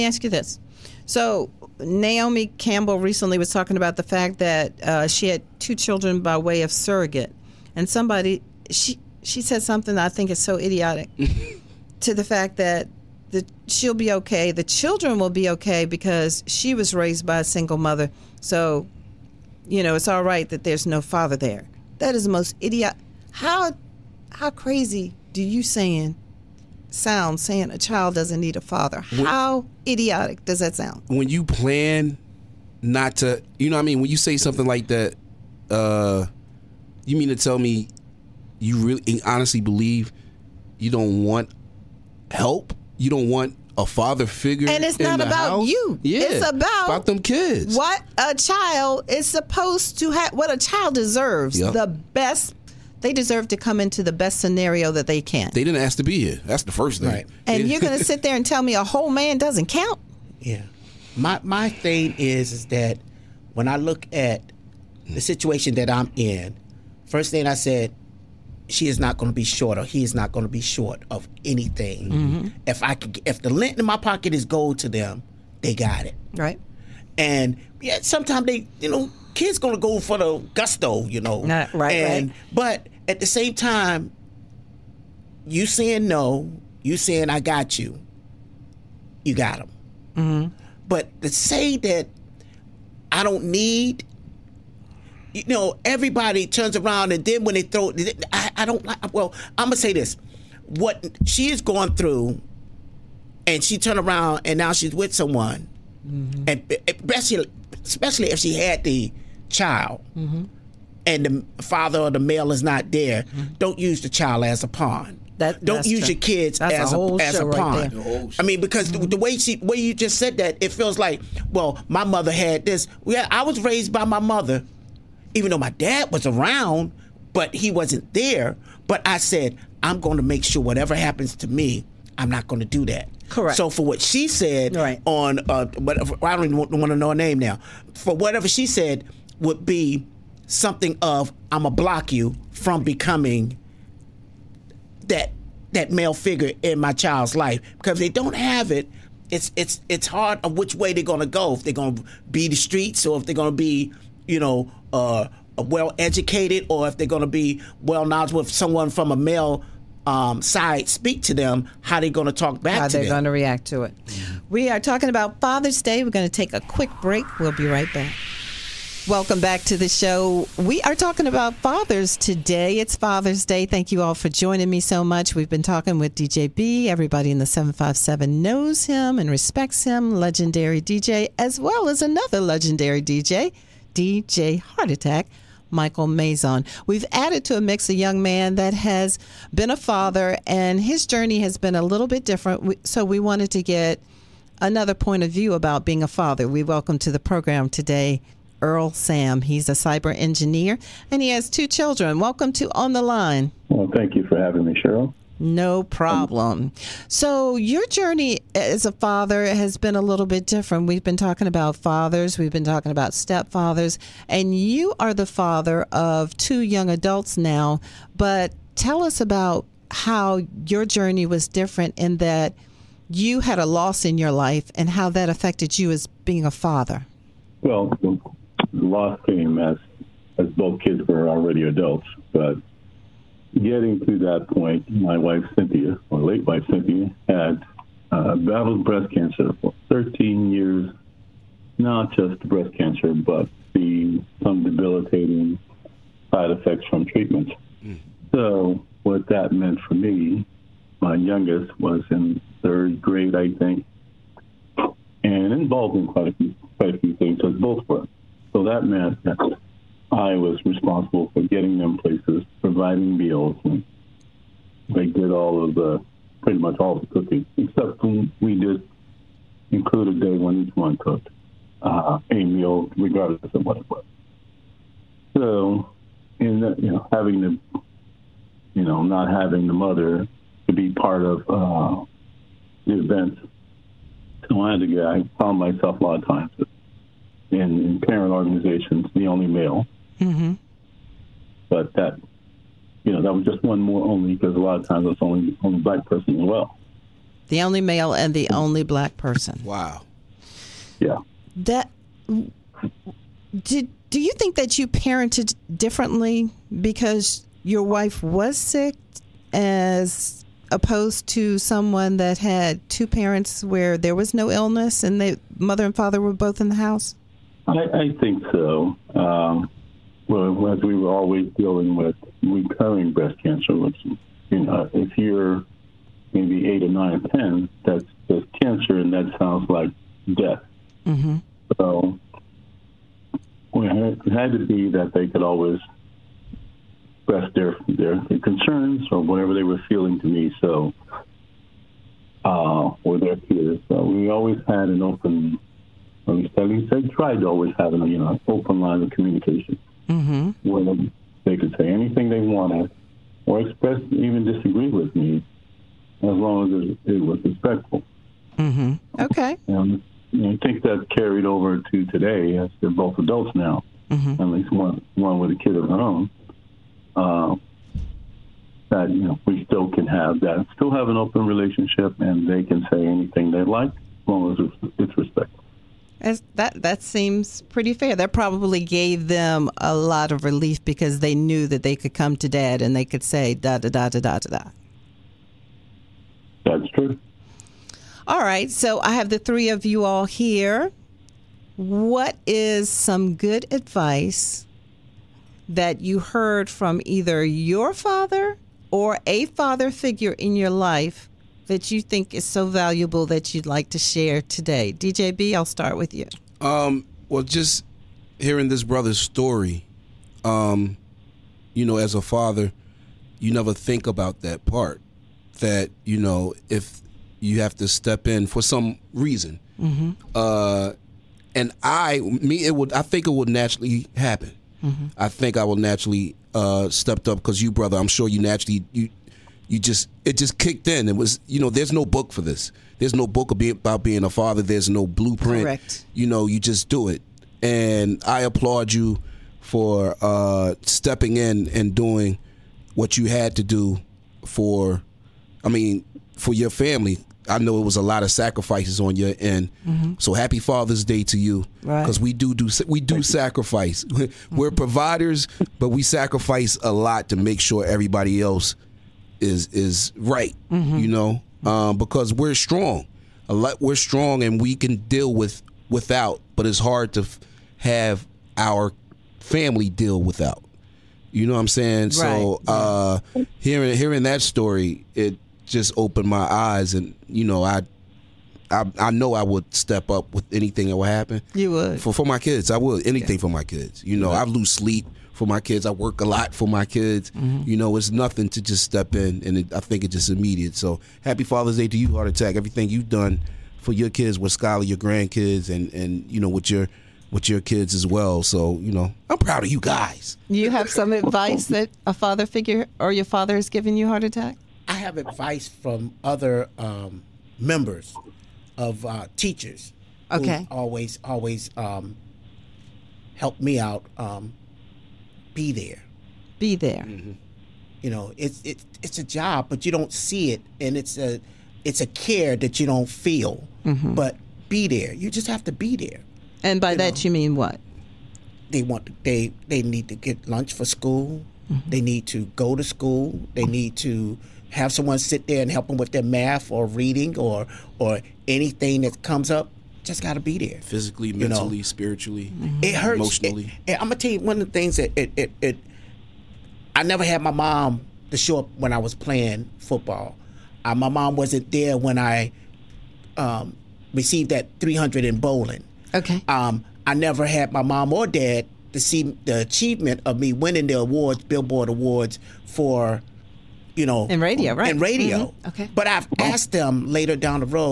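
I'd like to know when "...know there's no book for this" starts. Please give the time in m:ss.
7:11.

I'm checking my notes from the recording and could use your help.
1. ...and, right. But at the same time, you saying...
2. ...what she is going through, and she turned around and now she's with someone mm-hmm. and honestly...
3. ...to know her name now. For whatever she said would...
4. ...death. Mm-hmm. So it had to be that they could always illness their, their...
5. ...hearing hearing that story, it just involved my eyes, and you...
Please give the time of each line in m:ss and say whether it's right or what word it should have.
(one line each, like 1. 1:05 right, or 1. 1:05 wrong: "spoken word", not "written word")
1. 1:21 right
2. 1:40 wrong: "especially", not "honestly"
3. 2:16 right
4. 5:30 wrong: "express", not "illness"
5. 7:53 wrong: "opened", not "involved".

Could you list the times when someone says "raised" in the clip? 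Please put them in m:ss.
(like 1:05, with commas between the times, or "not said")
0:16, 2:03.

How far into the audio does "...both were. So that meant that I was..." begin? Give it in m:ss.
4:17.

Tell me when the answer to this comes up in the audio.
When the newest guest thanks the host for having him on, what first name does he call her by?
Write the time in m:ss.
3:24.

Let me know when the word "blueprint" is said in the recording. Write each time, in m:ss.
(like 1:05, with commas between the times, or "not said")
7:15.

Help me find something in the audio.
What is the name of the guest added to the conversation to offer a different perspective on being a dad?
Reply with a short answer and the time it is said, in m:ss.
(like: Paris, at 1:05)
Earl Sam, at 3:18.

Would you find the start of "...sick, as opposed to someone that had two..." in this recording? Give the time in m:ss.
5:08.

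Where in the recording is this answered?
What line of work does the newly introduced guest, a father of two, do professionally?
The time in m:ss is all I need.
3:19.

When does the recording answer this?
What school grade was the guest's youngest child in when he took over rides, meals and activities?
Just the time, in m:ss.
4:12.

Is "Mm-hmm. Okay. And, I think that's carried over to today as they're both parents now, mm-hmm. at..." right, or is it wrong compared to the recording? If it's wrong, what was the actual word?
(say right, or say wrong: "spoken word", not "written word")
wrong: "adults", not "parents".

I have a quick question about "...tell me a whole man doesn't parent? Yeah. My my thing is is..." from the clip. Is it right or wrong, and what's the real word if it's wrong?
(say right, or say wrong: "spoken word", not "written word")
wrong: "count", not "parent".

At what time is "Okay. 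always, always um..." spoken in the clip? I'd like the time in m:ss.
8:30.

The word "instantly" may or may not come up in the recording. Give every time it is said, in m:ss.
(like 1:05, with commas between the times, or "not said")
not said.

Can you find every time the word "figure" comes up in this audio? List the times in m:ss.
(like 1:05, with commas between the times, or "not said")
0:44, 2:26, 6:39, 8:22.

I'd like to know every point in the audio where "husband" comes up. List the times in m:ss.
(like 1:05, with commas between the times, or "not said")
not said.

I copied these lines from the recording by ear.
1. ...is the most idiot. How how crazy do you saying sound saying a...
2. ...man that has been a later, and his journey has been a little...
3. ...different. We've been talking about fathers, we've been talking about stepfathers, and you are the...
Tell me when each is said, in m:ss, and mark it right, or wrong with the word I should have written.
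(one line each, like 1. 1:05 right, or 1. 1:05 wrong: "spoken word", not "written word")
1. 0:22 right
2. 3:08 wrong: "father", not "later"
3. 3:30 right.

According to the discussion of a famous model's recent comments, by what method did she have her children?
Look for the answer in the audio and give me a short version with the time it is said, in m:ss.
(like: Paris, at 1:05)
surrogate, at 0:06.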